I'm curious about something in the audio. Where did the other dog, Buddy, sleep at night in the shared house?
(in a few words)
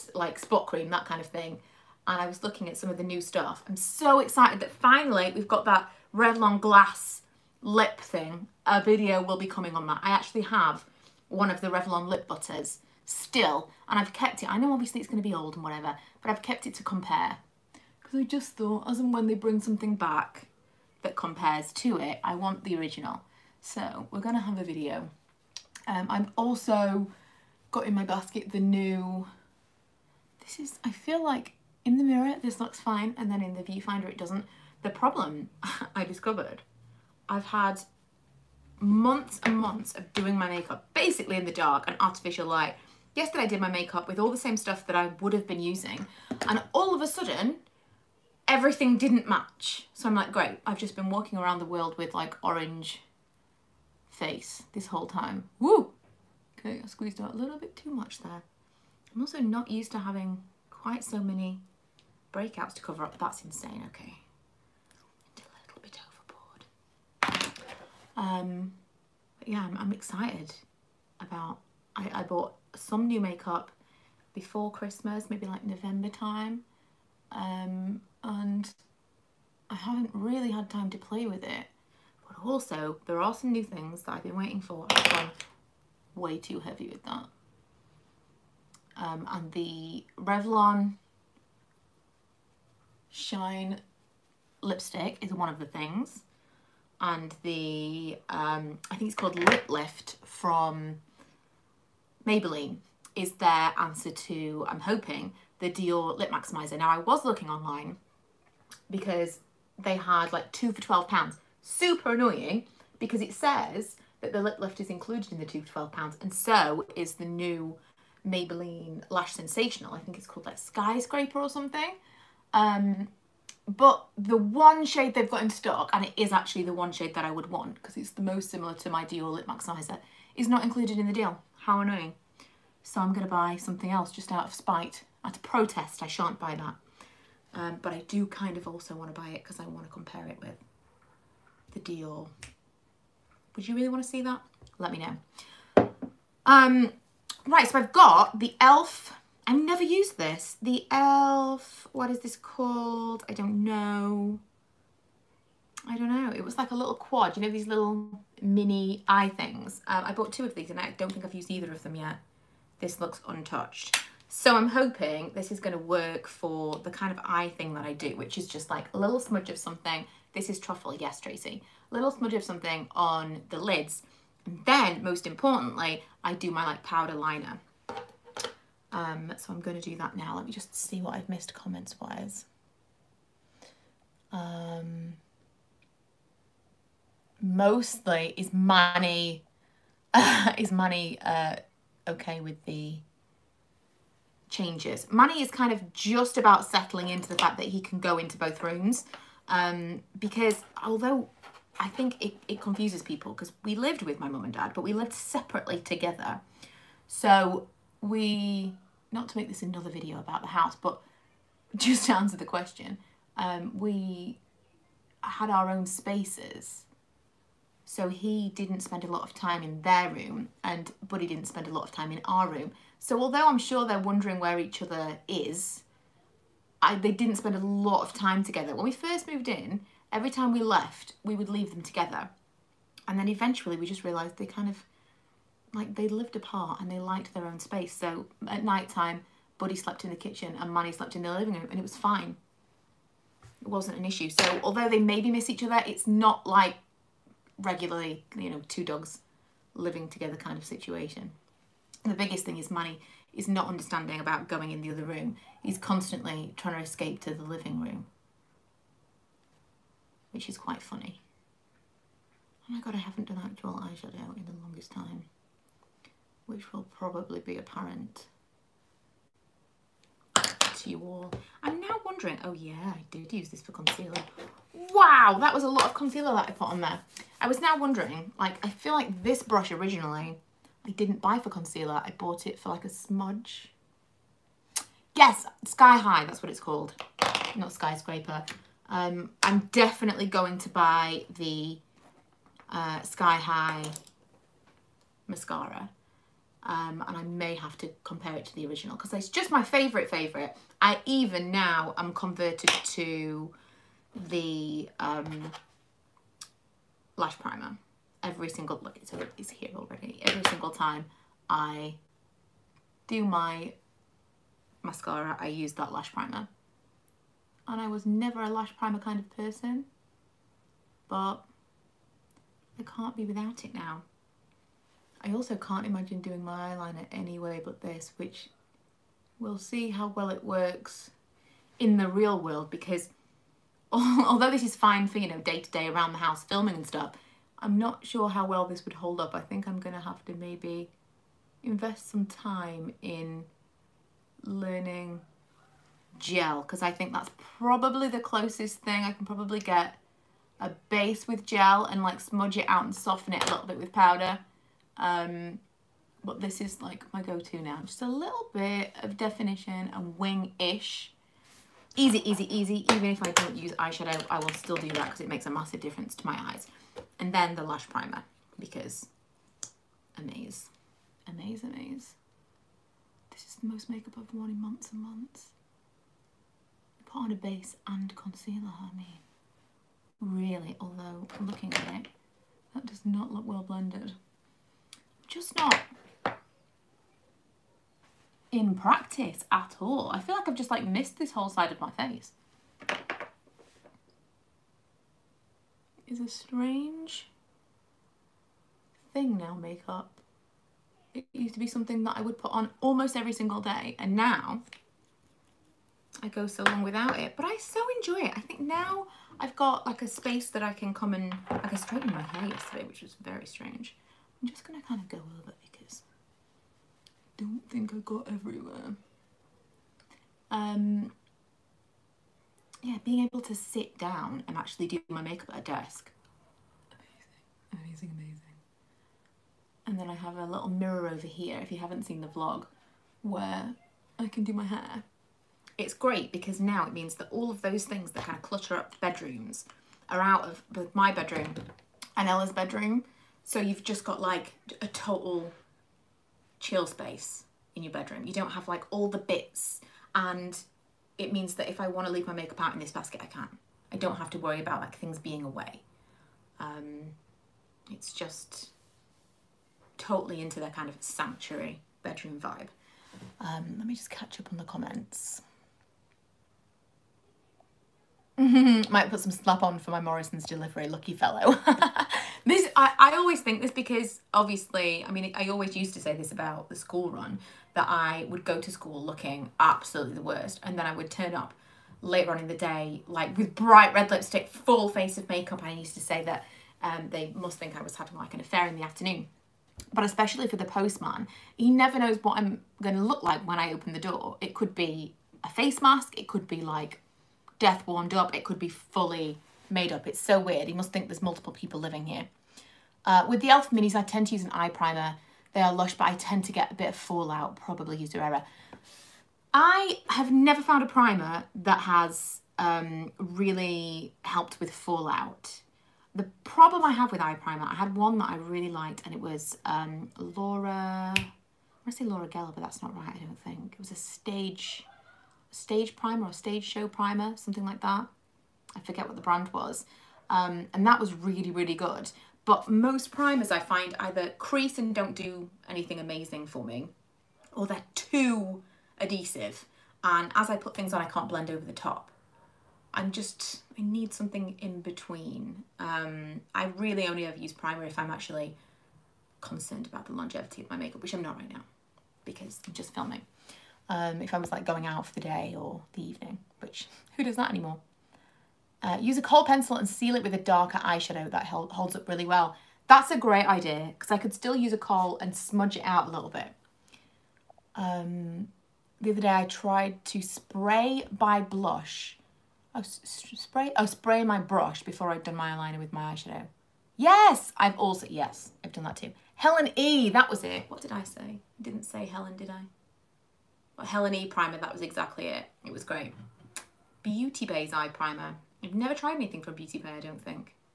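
The kitchen.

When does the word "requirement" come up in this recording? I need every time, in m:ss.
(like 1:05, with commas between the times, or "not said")
not said.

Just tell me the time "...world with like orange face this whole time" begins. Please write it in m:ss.
0:51.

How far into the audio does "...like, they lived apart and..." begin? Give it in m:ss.
3:55.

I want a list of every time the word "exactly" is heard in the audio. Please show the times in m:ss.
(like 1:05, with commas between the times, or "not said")
9:44.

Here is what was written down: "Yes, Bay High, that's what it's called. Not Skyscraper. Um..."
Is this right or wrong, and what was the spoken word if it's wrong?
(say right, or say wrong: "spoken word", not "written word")
wrong: "Sky", not "Bay".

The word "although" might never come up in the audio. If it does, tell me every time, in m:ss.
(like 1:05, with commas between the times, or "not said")
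3:20, 3:43, 4:04, 5:33, 6:20.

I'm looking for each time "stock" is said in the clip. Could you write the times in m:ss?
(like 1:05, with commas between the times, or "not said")
2:05.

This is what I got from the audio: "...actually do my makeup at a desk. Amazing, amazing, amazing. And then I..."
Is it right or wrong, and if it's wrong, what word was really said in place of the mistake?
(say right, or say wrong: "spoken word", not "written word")
right.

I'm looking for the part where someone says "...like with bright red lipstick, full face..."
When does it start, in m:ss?
8:03.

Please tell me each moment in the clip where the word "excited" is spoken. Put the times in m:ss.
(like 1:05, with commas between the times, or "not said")
0:04, 1:09.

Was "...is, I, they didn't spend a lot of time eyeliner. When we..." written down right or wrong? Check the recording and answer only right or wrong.
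wrong.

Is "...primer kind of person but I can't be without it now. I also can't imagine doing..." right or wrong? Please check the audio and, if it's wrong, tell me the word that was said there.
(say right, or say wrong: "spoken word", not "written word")
right.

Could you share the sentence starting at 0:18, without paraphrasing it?
Because I just thought, as and when they bring something back that compares to it, I want the original.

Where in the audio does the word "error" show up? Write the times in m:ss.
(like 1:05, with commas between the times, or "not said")
8:28.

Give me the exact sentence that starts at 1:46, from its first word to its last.
Now I was looking online because they had like two for £12.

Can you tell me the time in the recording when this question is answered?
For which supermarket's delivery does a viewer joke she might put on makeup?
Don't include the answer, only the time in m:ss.
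7:49.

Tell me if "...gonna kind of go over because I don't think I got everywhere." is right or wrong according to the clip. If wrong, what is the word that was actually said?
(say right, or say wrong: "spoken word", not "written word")
right.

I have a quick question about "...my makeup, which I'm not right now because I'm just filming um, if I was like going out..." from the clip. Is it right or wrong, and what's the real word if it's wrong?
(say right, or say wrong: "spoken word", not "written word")
right.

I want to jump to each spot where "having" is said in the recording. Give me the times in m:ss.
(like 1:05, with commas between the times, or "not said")
0:59, 8:07.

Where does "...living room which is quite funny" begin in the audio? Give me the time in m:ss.
4:17.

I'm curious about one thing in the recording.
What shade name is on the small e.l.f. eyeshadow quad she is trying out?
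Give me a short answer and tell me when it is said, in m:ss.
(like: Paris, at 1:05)
Truffle, at 2:50.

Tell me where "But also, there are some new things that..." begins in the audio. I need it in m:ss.
1:22.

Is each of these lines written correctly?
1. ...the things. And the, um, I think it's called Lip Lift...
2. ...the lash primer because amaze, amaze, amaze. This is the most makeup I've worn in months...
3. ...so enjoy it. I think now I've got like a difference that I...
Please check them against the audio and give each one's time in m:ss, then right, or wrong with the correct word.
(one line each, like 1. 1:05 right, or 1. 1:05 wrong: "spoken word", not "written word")
1. 1:35 right
2. 6:07 right
3. 6:47 wrong: "space", not "difference".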